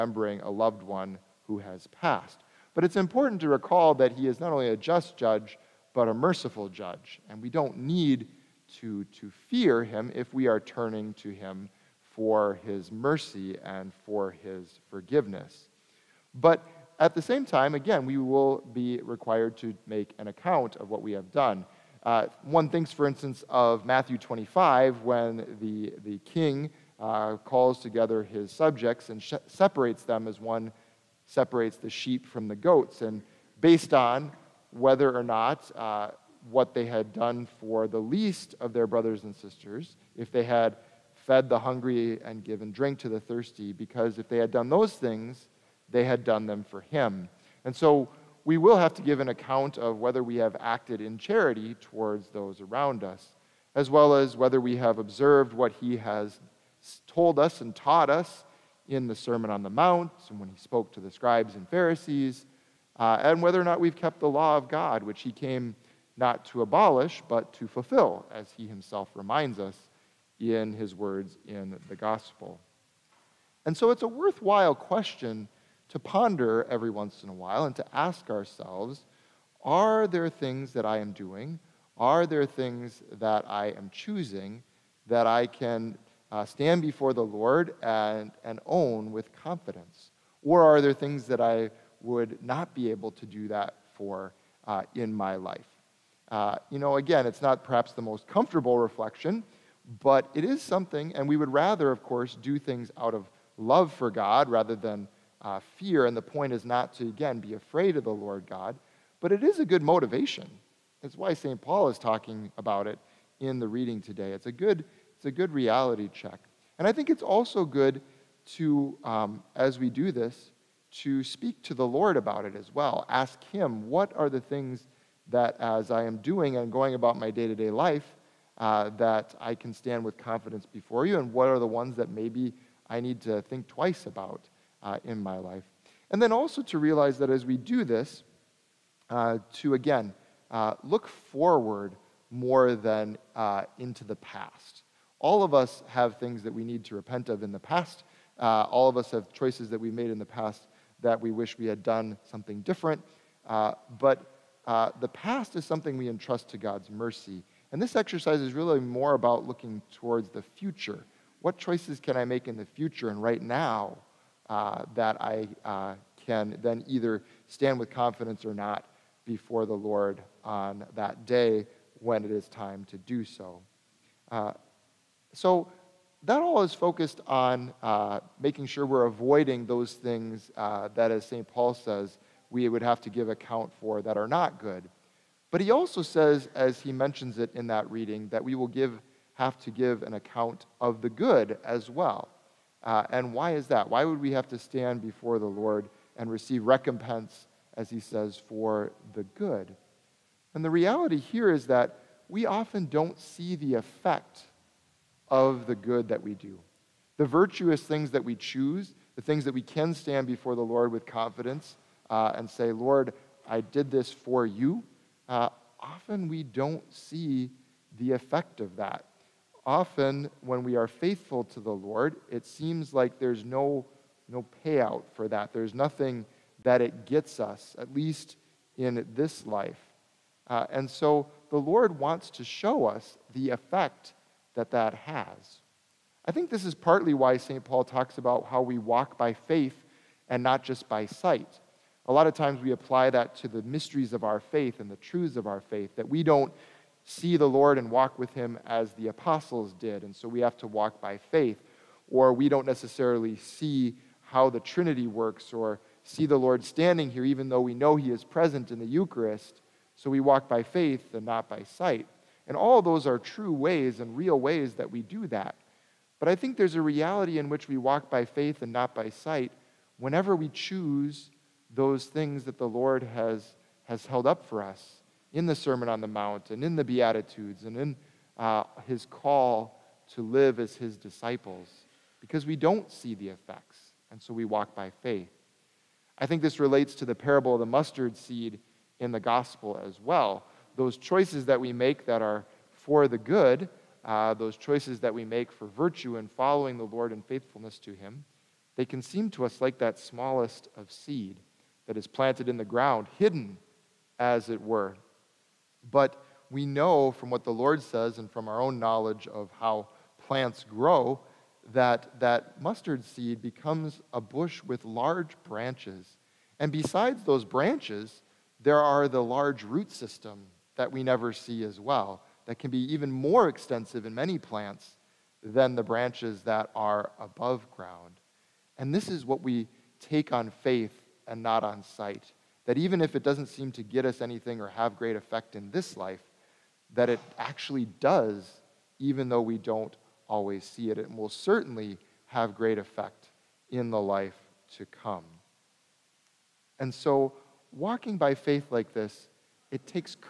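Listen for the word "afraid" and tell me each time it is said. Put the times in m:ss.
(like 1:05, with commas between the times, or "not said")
1:47.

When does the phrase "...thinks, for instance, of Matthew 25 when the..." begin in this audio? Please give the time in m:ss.
0:22.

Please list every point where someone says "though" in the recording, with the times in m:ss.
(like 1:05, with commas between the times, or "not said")
4:17, 5:39.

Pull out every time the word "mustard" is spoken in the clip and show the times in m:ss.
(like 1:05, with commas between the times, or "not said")
4:47, 5:12.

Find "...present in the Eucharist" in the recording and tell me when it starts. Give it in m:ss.
4:18.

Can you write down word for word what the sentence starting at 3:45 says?
There's nothing that it gets us, at least in this life.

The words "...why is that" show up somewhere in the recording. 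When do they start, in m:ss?
3:13.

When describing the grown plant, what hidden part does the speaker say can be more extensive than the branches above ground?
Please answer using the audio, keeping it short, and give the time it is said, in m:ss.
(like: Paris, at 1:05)
root system, at 5:19.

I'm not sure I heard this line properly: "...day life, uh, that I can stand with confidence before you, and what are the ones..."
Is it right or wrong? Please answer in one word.
right.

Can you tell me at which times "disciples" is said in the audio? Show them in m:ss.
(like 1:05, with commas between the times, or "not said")
4:40.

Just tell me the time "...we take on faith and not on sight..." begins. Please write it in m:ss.
5:29.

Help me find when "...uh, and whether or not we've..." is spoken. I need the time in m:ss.
1:02.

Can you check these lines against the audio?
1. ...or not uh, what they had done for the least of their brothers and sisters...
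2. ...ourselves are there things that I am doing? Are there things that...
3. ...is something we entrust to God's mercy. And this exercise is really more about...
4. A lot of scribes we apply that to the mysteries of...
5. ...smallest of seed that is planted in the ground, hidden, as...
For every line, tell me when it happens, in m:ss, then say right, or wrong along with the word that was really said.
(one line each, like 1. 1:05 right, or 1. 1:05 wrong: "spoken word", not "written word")
1. 0:35 right
2. 1:18 right
3. 2:35 right
4. 4:02 wrong: "times", not "scribes"
5. 4:59 right.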